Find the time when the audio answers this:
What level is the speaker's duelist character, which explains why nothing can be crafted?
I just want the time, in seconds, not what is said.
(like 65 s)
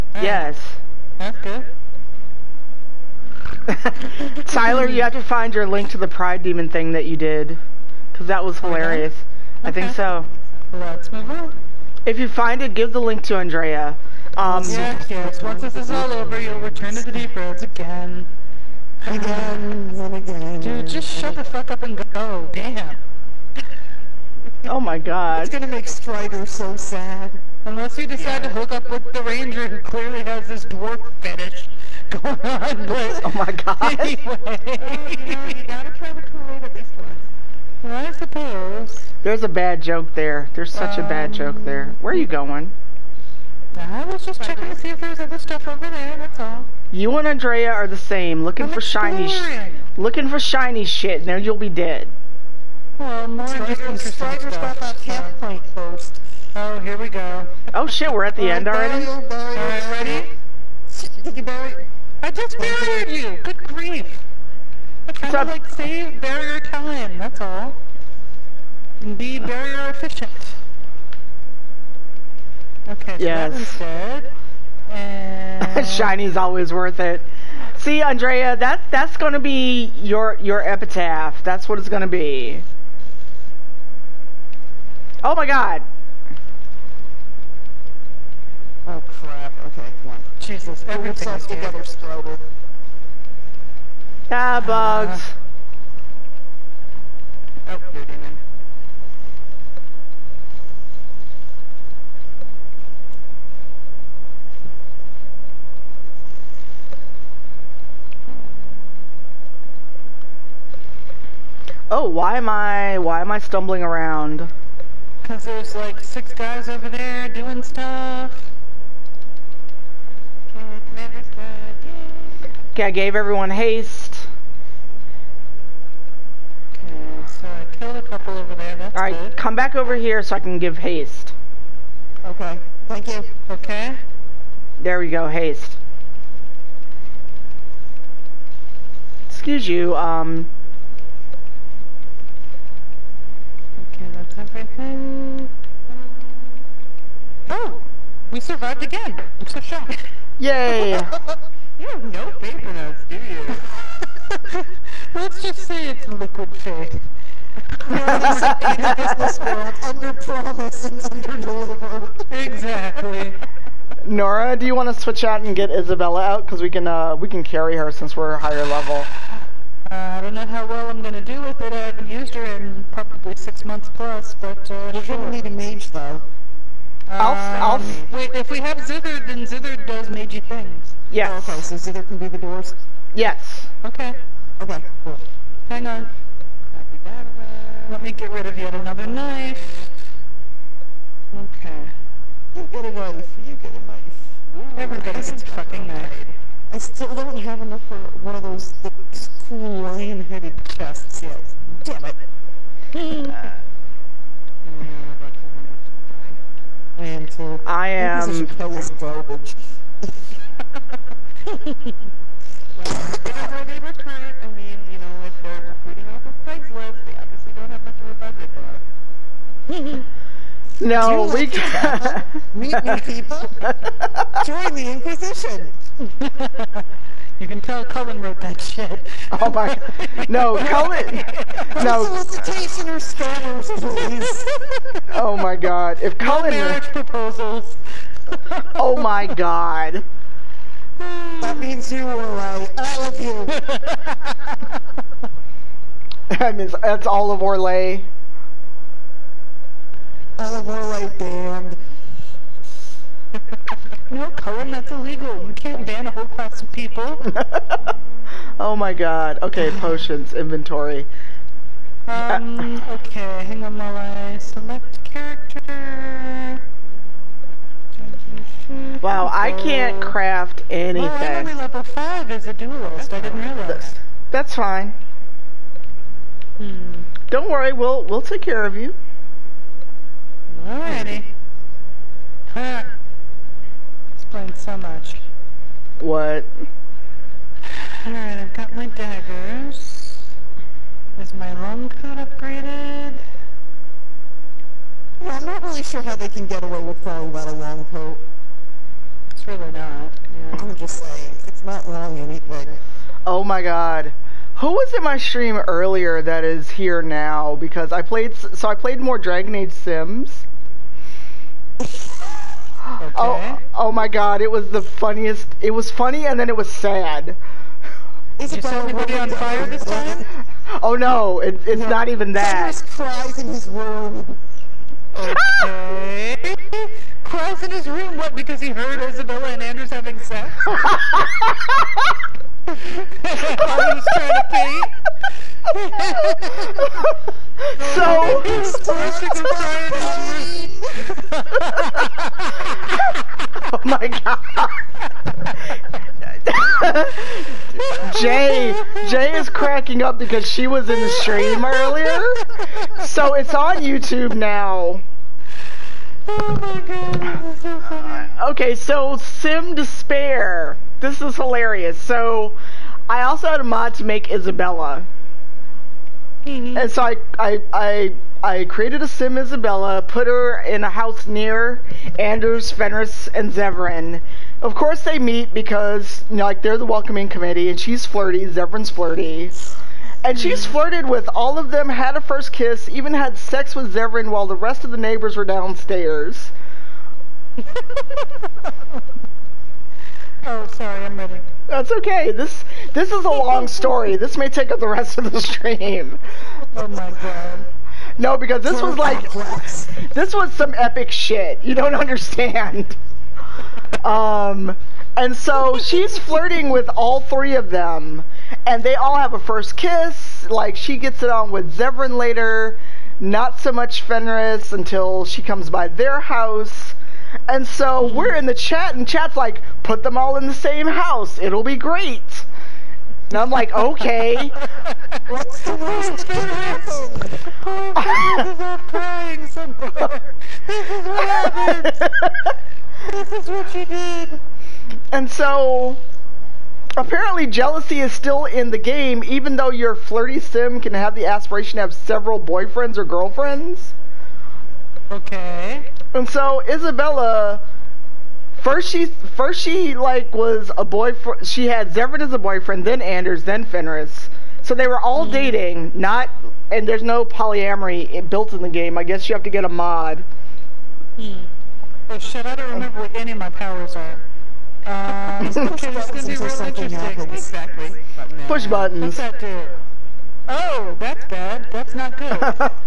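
271 s.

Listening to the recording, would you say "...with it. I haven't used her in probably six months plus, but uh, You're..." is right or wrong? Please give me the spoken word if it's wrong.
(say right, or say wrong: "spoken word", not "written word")
right.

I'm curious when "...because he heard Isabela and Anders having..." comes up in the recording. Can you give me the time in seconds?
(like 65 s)
328 s.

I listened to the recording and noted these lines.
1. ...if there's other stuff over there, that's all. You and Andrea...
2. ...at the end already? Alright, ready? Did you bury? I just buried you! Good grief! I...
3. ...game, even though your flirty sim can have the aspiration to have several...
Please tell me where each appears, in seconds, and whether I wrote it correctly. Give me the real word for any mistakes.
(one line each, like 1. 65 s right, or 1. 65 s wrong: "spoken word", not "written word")
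1. 44 s right
2. 58 s right
3. 438 s right.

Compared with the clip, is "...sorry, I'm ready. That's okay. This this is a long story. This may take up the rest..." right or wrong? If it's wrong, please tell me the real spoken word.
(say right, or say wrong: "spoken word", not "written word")
right.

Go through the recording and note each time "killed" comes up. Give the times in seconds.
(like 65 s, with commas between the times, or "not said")
127 s.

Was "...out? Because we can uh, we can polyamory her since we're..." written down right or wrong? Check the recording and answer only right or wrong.
wrong.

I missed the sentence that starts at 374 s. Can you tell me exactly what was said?
Of course they meet because, you know, like, they're the welcoming committee, and she's flirty, Zevran's flirty.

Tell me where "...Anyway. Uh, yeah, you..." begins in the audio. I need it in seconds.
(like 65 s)
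33 s.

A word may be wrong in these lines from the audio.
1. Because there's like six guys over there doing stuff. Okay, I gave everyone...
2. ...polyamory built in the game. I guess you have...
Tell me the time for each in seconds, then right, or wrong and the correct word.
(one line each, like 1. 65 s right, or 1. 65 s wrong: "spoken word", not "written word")
1. 115 s right
2. 457 s right.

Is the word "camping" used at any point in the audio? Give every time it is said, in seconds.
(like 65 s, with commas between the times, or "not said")
not said.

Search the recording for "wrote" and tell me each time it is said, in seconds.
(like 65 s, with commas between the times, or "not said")
228 s.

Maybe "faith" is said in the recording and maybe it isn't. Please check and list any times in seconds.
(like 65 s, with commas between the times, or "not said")
152 s, 156 s.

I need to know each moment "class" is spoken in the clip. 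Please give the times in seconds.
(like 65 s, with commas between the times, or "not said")
256 s.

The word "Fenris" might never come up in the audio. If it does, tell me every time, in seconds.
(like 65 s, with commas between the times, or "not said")
372 s, 414 s, 453 s.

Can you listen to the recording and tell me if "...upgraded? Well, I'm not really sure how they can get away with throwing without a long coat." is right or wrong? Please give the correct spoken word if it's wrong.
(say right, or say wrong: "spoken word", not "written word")
right.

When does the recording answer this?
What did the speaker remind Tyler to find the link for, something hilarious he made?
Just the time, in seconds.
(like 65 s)
6 s.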